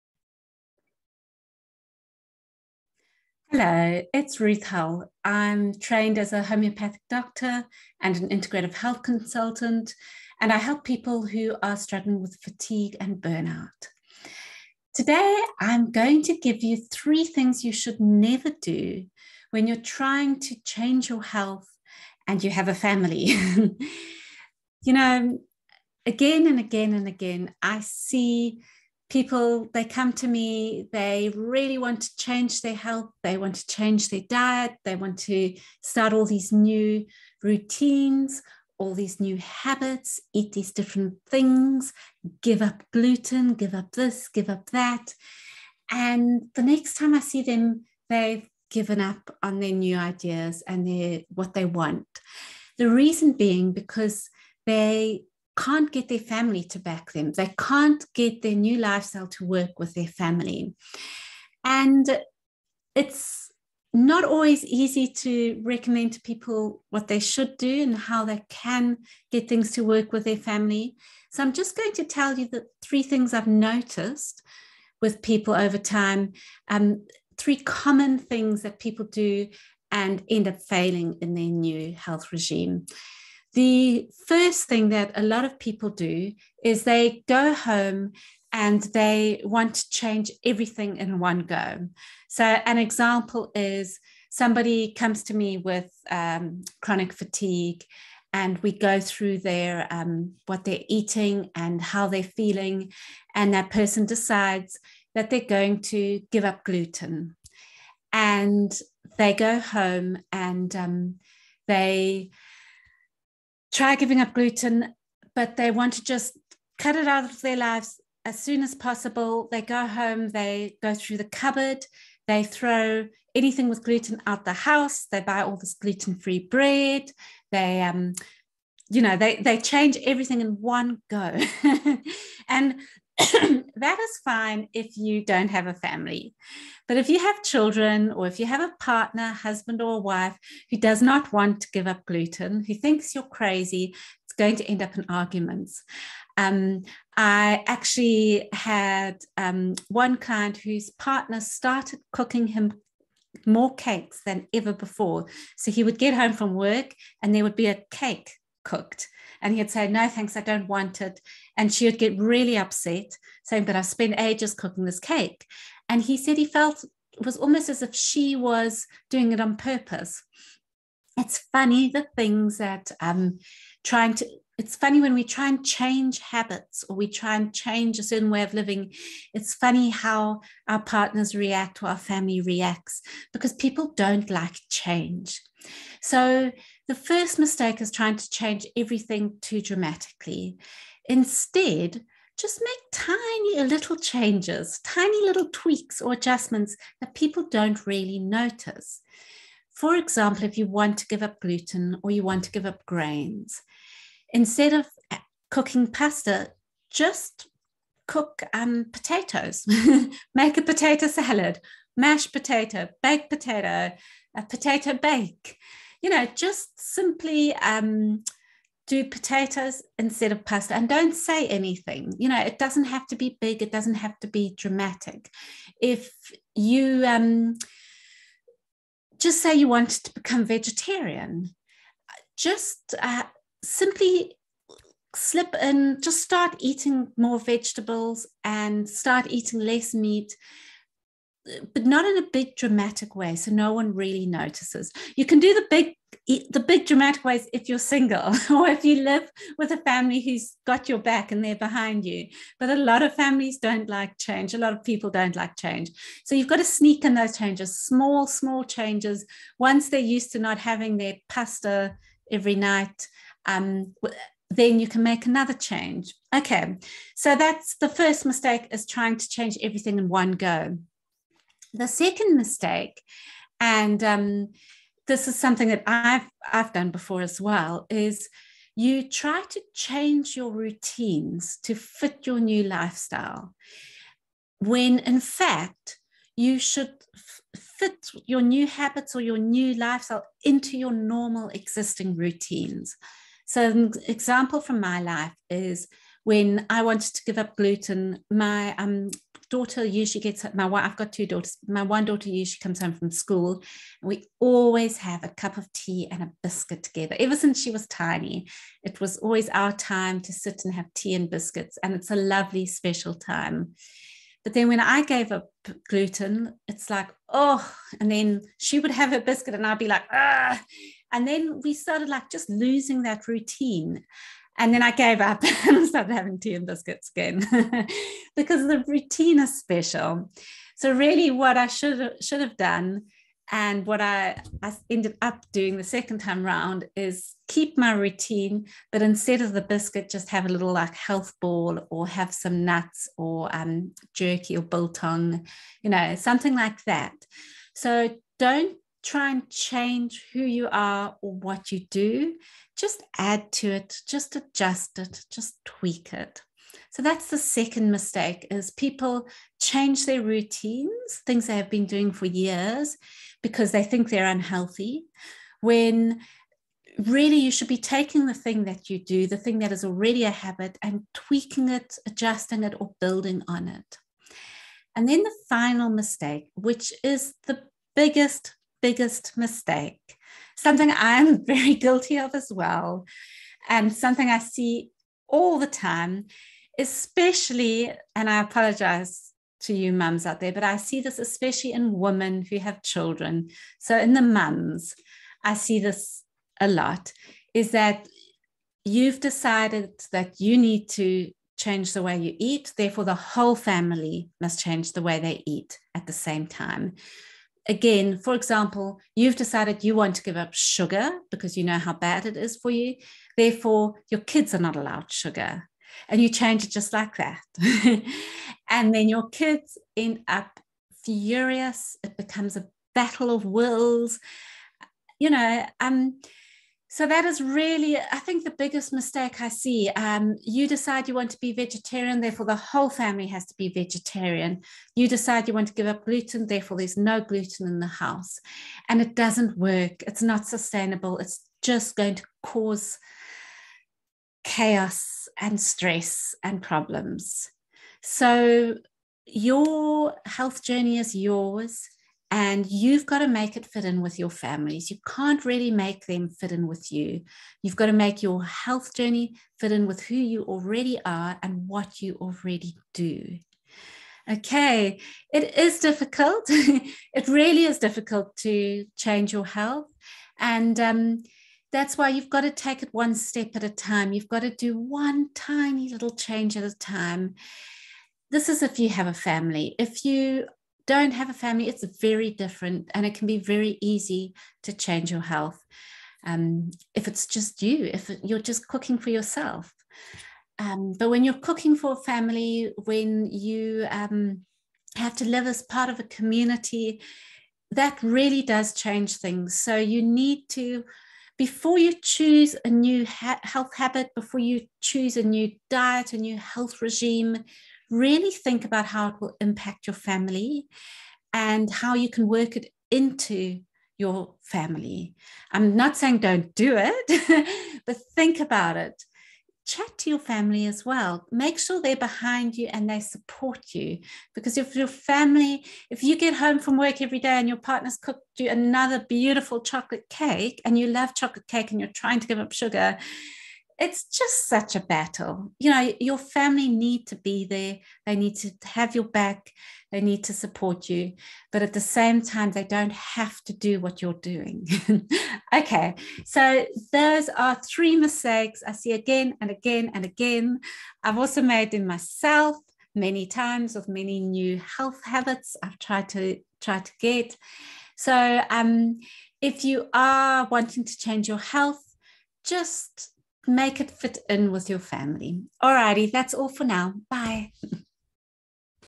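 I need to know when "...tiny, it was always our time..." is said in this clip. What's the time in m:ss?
5:07.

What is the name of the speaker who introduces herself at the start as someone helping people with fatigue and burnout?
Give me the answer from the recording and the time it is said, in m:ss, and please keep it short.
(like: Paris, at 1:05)
Ruth Hull, at 0:04.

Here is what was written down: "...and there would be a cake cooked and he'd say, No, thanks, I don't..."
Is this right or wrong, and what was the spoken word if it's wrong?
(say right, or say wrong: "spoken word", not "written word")
right.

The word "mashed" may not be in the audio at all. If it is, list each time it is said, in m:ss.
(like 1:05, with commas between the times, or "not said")
3:31.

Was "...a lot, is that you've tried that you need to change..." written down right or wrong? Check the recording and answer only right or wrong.
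wrong.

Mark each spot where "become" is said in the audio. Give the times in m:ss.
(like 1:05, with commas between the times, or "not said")
3:50, 7:02.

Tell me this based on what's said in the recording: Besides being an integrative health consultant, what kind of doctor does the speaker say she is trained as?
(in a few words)
Homeopathic doctor.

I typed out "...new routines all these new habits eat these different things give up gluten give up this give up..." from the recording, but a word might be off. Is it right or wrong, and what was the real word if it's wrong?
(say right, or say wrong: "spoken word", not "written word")
right.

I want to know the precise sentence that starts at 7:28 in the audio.
So your health journey is yours and you've got to make it fit in with your families.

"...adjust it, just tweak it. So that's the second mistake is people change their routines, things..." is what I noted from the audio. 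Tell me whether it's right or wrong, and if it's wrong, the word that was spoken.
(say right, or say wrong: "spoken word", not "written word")
right.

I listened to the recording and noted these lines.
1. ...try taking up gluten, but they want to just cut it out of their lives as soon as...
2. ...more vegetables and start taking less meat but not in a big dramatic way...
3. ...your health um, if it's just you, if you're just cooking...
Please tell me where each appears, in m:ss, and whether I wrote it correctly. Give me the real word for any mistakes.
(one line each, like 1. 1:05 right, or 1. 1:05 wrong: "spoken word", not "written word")
1. 1:53 wrong: "giving", not "taking"
2. 3:57 wrong: "eating", not "taking"
3. 8:05 right.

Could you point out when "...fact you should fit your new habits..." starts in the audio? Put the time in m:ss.
4:45.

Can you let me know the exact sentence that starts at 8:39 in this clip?
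Chat to your family as well.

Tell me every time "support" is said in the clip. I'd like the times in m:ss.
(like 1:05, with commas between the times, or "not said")
8:42, 9:00.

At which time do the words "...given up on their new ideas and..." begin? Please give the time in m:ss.
0:48.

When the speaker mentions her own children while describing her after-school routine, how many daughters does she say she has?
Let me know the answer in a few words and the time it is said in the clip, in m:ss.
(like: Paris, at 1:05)
2, at 5:01.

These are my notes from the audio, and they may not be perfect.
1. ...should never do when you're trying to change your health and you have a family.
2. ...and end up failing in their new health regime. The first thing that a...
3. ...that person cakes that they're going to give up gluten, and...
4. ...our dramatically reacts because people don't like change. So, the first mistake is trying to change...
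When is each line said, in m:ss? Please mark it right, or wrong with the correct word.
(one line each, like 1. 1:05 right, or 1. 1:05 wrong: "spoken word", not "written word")
1. 0:17 right
2. 1:19 right
3. 1:43 wrong: "decides", not "cakes"
4. 3:01 wrong: "family", not "dramatically".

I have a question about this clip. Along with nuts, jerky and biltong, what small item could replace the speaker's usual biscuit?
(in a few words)
Health ball.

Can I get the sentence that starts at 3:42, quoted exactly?
You know, it doesn't have to be big, it doesn't have to be dramatic.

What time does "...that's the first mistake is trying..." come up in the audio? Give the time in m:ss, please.
4:27.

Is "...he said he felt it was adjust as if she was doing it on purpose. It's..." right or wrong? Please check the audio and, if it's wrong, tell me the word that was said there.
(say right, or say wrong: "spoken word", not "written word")
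wrong: "almost", not "adjust".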